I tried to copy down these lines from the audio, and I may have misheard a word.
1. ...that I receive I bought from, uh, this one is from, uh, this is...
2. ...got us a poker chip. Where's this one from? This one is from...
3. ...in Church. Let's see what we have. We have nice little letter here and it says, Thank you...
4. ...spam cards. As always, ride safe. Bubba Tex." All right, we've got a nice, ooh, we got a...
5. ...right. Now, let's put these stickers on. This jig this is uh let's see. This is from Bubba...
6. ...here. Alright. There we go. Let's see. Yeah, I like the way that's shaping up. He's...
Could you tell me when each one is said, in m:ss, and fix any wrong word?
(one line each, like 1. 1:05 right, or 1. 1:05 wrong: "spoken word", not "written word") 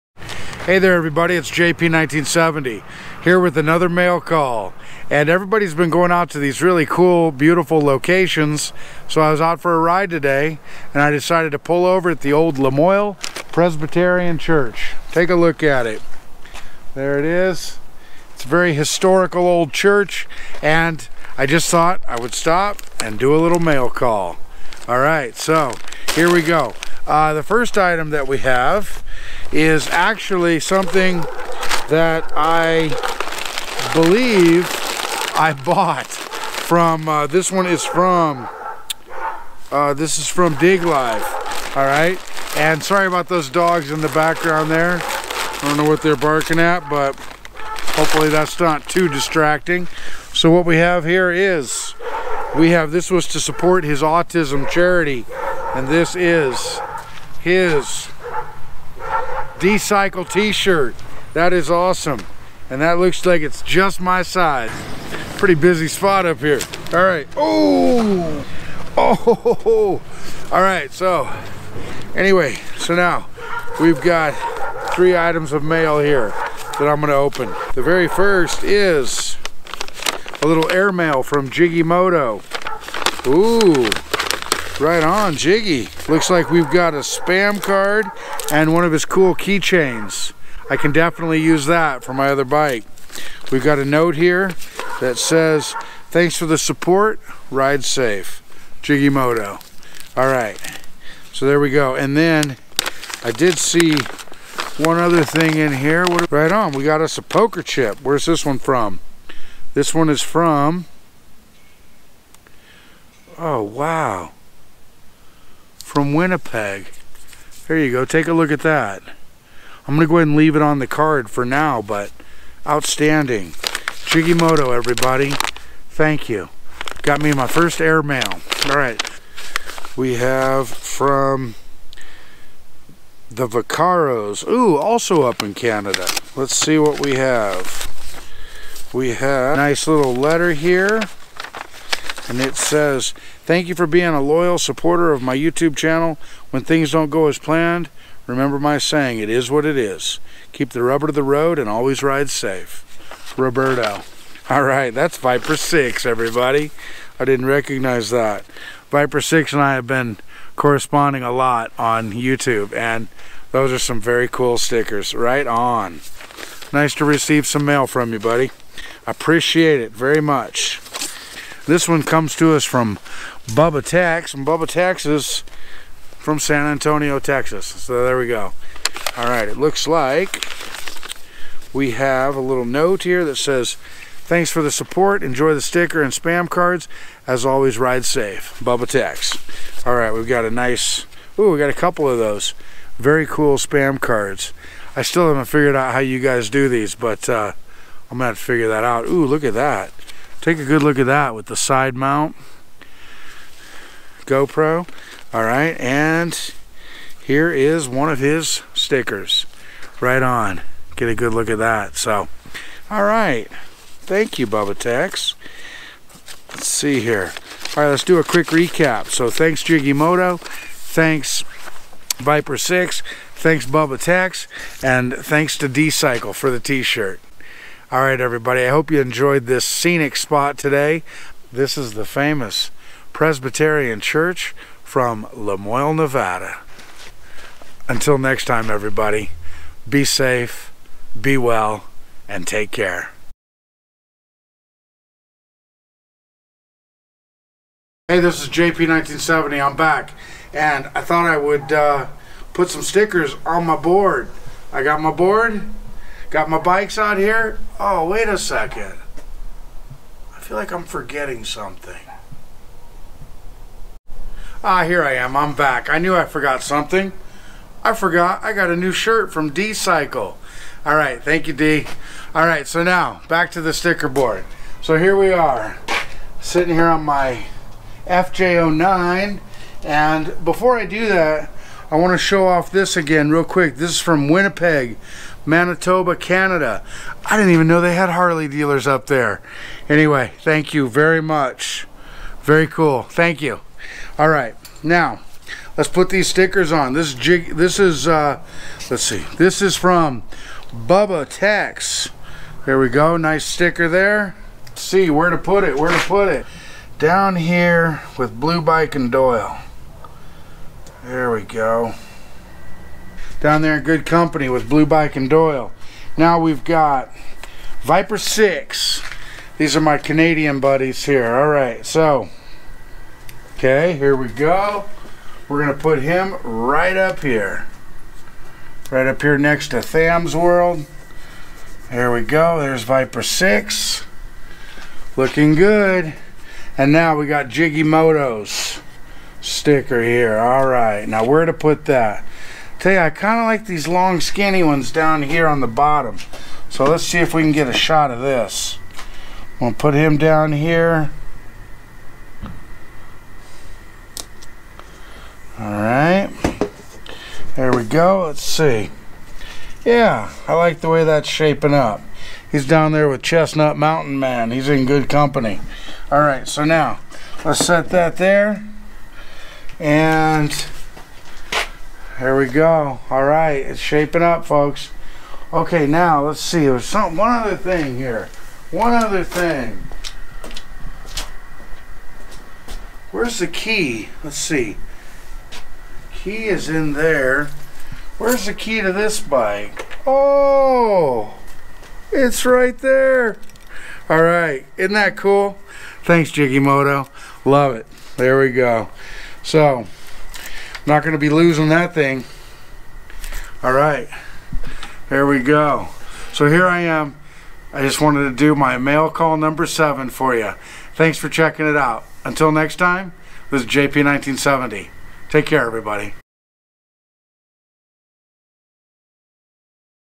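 1. 0:31 wrong: "believe", not "receive"
2. 1:46 right
3. 2:15 wrong: "Canada", not "Church"
4. 3:06 right
5. 4:54 right
6. 5:50 right.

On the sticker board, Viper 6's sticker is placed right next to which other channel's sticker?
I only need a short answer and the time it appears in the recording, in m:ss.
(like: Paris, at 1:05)
Tham's World, at 5:29.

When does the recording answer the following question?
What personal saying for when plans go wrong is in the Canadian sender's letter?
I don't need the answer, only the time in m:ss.
2:29.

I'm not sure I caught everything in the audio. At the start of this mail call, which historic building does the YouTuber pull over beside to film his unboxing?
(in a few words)
Lamoille Presbyterian Church.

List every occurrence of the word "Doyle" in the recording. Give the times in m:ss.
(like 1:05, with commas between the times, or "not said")
5:09, 5:15.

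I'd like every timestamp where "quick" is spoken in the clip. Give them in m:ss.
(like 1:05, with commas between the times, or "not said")
3:38, 4:43.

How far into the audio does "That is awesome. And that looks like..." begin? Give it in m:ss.
1:01.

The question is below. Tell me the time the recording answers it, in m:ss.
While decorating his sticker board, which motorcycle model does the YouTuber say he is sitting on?
4:38.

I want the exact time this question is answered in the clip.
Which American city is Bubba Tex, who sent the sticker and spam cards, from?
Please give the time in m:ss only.
2:56.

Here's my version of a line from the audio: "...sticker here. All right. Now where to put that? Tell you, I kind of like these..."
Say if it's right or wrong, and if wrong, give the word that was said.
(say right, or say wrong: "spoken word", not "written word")
right.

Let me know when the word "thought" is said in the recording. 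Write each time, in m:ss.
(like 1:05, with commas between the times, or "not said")
0:21, 4:11.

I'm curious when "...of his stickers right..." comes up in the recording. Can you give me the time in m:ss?
3:28.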